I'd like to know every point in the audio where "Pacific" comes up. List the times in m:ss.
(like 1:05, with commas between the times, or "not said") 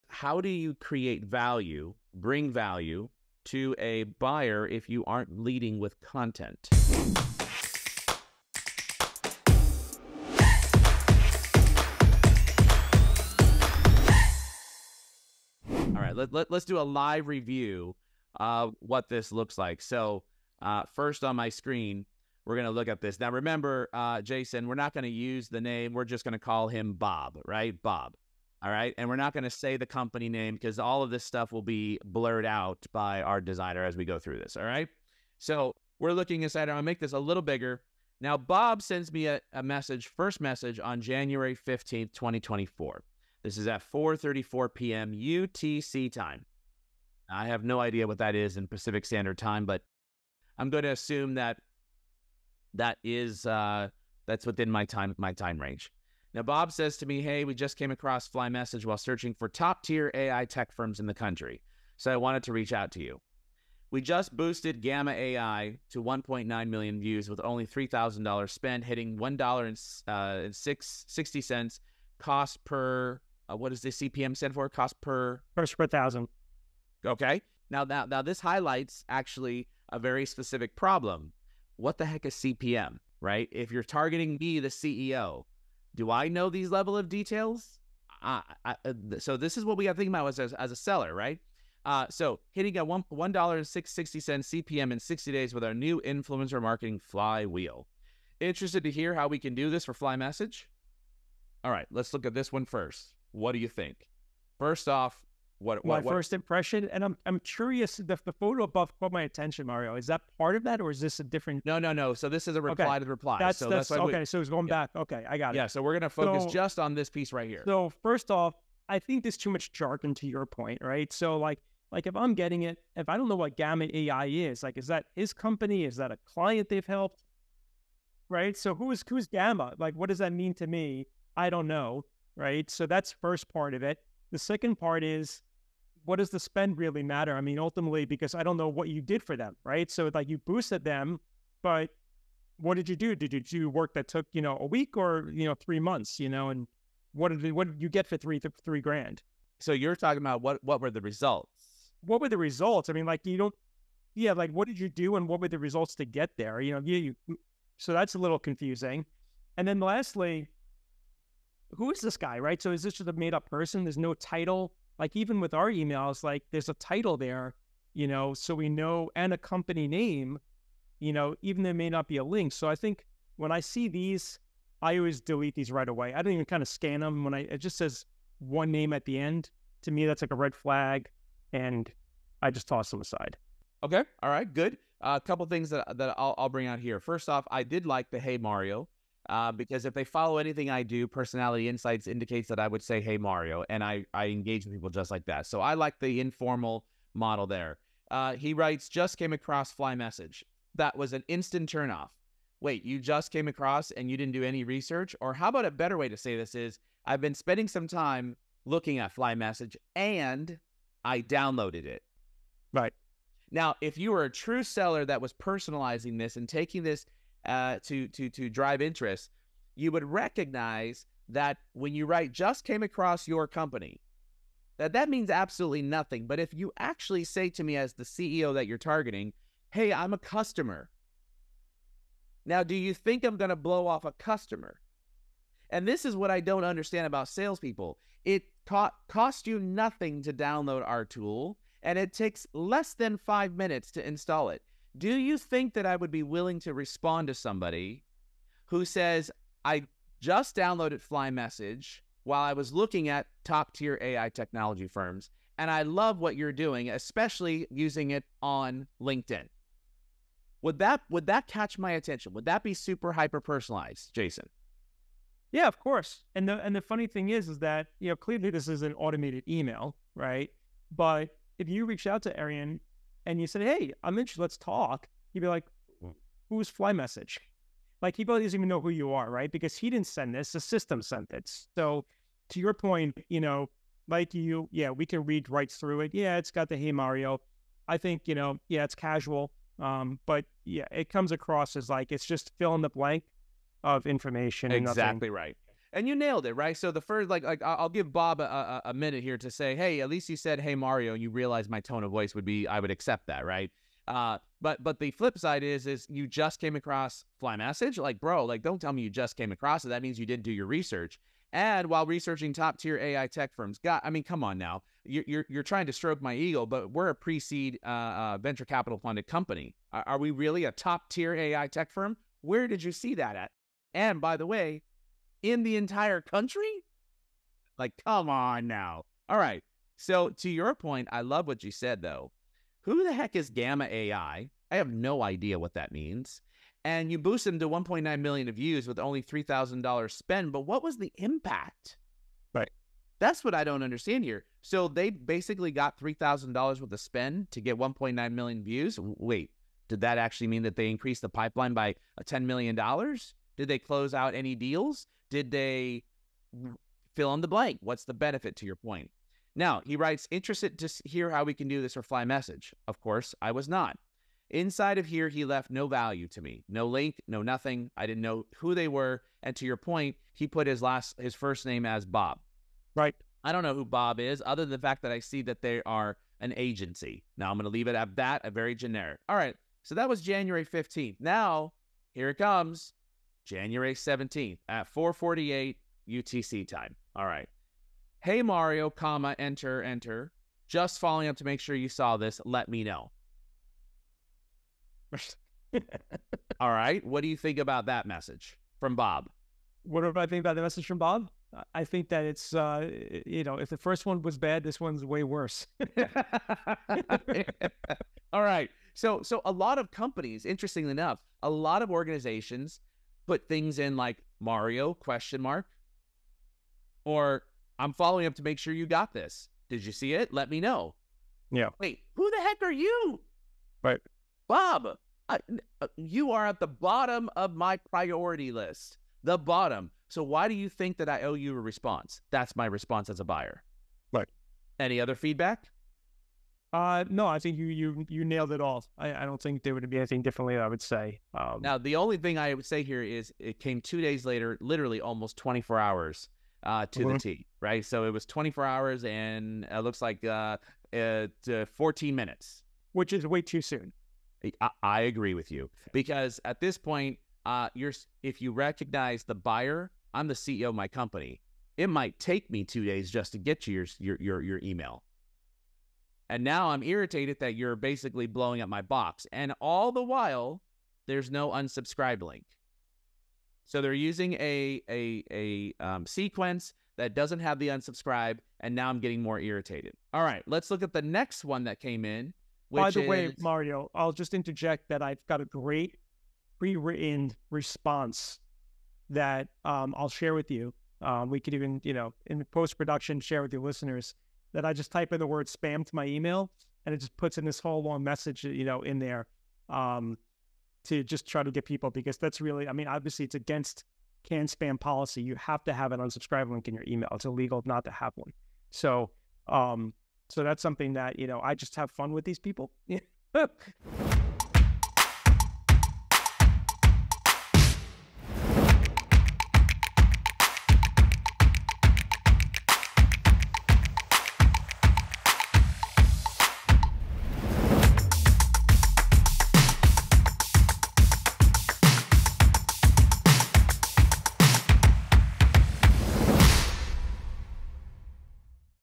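0:48.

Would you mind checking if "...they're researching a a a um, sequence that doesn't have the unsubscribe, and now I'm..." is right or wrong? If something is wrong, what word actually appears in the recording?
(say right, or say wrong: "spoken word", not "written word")
wrong: "using", not "researching".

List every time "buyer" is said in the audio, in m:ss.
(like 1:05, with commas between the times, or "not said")
0:04, 7:13, 7:39.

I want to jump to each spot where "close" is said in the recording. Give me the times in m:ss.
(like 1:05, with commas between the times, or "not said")
5:53.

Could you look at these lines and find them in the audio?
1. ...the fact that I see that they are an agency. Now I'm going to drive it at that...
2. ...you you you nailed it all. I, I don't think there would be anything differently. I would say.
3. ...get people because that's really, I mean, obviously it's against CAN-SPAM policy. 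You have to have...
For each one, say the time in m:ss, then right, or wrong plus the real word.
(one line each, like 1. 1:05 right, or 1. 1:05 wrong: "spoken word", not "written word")
1. 6:14 wrong: "leave", not "drive"
2. 7:17 right
3. 8:21 right.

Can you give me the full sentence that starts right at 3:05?
Uh, a couple things that that I'll, I'll bring out here.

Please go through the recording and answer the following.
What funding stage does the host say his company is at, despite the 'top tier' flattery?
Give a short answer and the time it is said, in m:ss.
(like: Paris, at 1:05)
pre-seed, at 5:17.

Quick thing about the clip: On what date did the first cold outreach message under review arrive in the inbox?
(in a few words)
January 15th, 2024.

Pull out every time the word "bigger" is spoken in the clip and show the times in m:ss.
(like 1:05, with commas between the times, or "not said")
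0:37.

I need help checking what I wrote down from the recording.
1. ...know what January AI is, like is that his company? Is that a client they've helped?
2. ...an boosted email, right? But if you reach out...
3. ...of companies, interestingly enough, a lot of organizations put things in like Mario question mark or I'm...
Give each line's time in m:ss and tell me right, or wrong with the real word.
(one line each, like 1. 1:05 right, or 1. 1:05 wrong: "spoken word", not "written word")
1. 2:03 wrong: "Gamma", not "January"
2. 4:28 wrong: "automated", not "boosted"
3. 6:49 right.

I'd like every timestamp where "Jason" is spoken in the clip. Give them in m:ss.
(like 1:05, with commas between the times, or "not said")
0:24, 4:24.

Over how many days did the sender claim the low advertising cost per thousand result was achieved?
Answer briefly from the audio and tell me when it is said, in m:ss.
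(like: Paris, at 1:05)
60, at 1:34.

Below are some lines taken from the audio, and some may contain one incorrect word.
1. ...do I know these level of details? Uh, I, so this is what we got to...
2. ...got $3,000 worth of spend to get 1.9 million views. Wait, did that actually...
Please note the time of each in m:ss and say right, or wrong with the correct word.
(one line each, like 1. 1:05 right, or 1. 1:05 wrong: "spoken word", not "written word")
1. 1:25 right
2. 5:45 right.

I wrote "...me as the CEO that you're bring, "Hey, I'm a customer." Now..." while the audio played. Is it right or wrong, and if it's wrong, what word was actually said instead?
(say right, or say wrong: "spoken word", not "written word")
wrong: "targeting", not "bring".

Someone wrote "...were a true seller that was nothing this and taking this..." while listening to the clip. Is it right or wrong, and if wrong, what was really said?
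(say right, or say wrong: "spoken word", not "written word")
wrong: "personalizing", not "nothing".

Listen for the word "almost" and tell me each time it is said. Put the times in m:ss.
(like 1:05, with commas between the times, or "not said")
7:25.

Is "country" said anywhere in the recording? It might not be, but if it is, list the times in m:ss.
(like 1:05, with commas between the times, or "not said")
1:01, 5:26.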